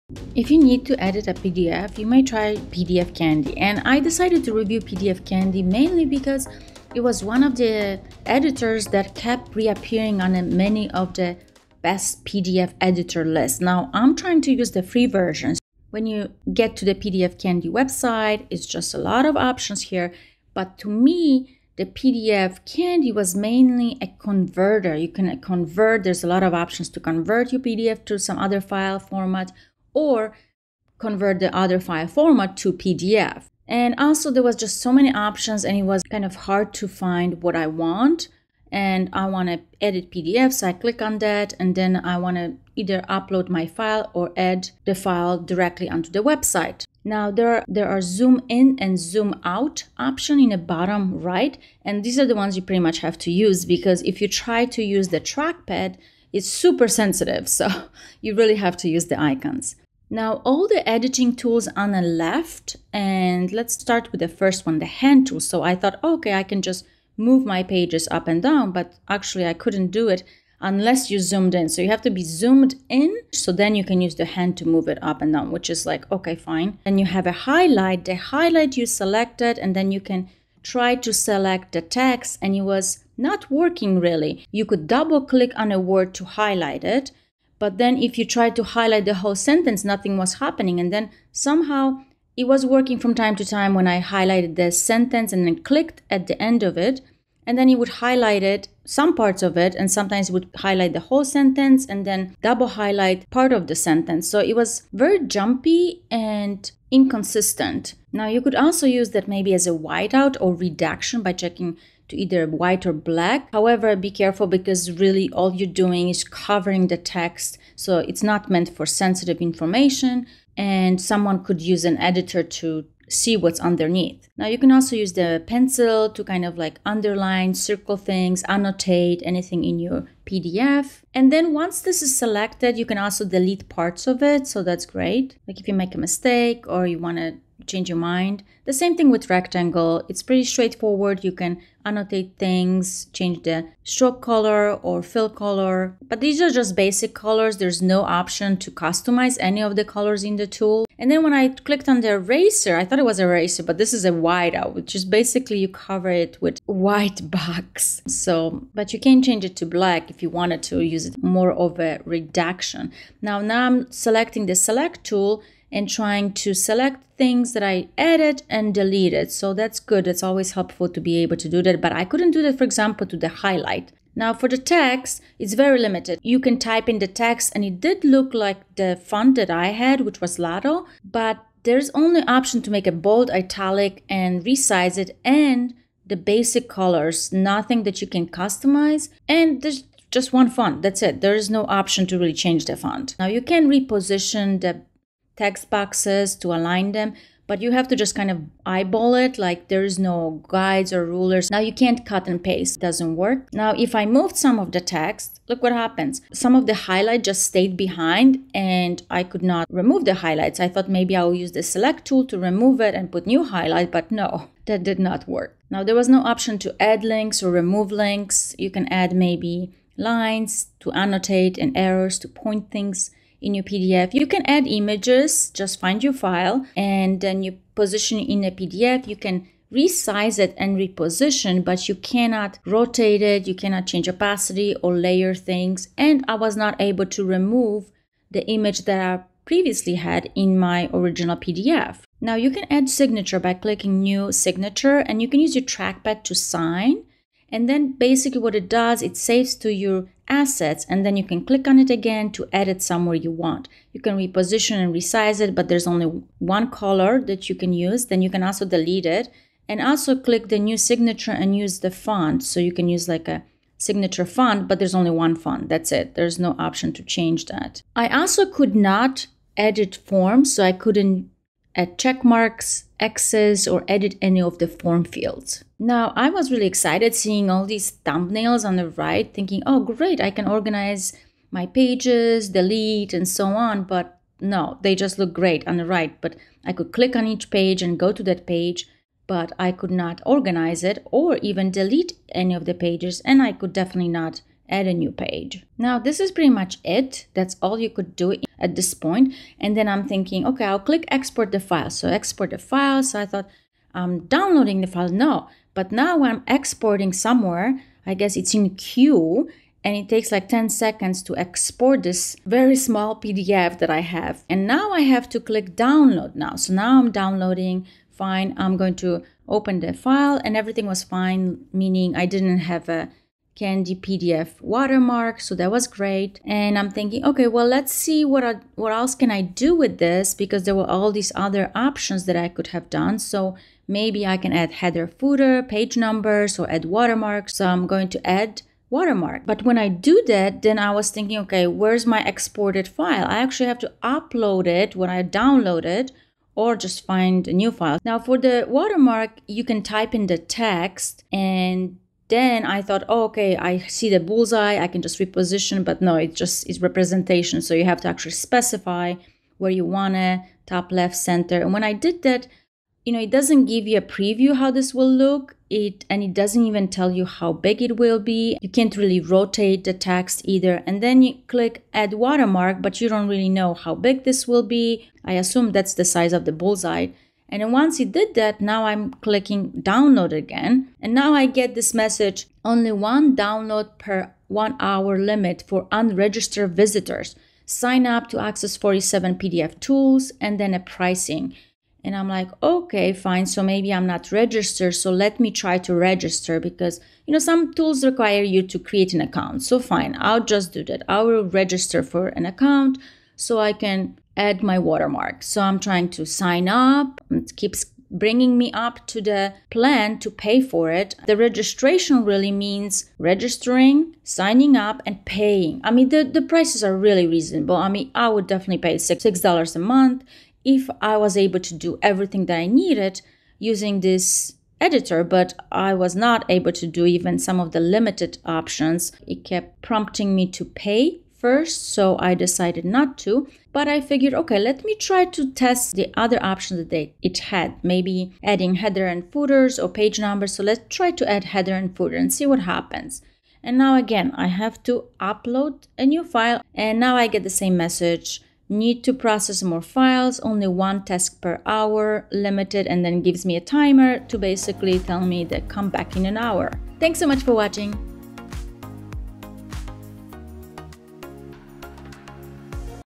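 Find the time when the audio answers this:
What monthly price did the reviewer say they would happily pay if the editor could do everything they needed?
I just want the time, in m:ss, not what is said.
6:59.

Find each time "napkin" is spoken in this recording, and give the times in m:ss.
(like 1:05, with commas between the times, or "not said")
not said.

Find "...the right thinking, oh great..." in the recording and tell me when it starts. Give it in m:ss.
4:38.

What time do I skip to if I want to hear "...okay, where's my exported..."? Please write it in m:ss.
5:41.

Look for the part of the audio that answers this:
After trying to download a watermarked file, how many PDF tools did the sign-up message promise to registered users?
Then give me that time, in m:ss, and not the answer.
6:28.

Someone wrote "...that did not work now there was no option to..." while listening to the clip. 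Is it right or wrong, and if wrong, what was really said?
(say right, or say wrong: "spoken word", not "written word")
right.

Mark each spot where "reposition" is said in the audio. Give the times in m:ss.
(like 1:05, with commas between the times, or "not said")
3:13, 3:50, 4:14, 5:55.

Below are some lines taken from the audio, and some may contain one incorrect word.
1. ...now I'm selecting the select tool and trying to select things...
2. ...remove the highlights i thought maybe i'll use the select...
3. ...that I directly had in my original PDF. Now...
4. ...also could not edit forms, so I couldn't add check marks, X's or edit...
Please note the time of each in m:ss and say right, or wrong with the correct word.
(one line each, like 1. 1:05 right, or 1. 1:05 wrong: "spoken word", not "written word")
1. 2:43 right
2. 3:29 right
3. 3:58 wrong: "previously", not "directly"
4. 4:28 right.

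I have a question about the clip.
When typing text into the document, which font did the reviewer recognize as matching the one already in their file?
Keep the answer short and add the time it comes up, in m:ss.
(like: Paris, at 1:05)
Lato, at 3:00.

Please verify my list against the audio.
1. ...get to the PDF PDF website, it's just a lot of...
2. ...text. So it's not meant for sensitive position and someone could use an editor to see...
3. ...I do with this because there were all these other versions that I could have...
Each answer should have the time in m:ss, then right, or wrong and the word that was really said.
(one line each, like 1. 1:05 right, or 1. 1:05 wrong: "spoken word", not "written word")
1. 0:16 wrong: "Candy", not "PDF"
2. 1:56 wrong: "information", not "position"
3. 5:29 wrong: "options", not "versions".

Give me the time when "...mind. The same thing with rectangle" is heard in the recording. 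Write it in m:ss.
2:17.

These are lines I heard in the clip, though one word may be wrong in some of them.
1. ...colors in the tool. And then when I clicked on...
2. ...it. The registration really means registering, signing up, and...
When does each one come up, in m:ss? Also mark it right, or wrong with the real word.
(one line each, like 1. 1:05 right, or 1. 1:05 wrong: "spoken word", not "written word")
1. 2:29 right
2. 6:50 right.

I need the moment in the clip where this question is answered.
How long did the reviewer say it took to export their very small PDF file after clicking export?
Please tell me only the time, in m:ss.
5:10.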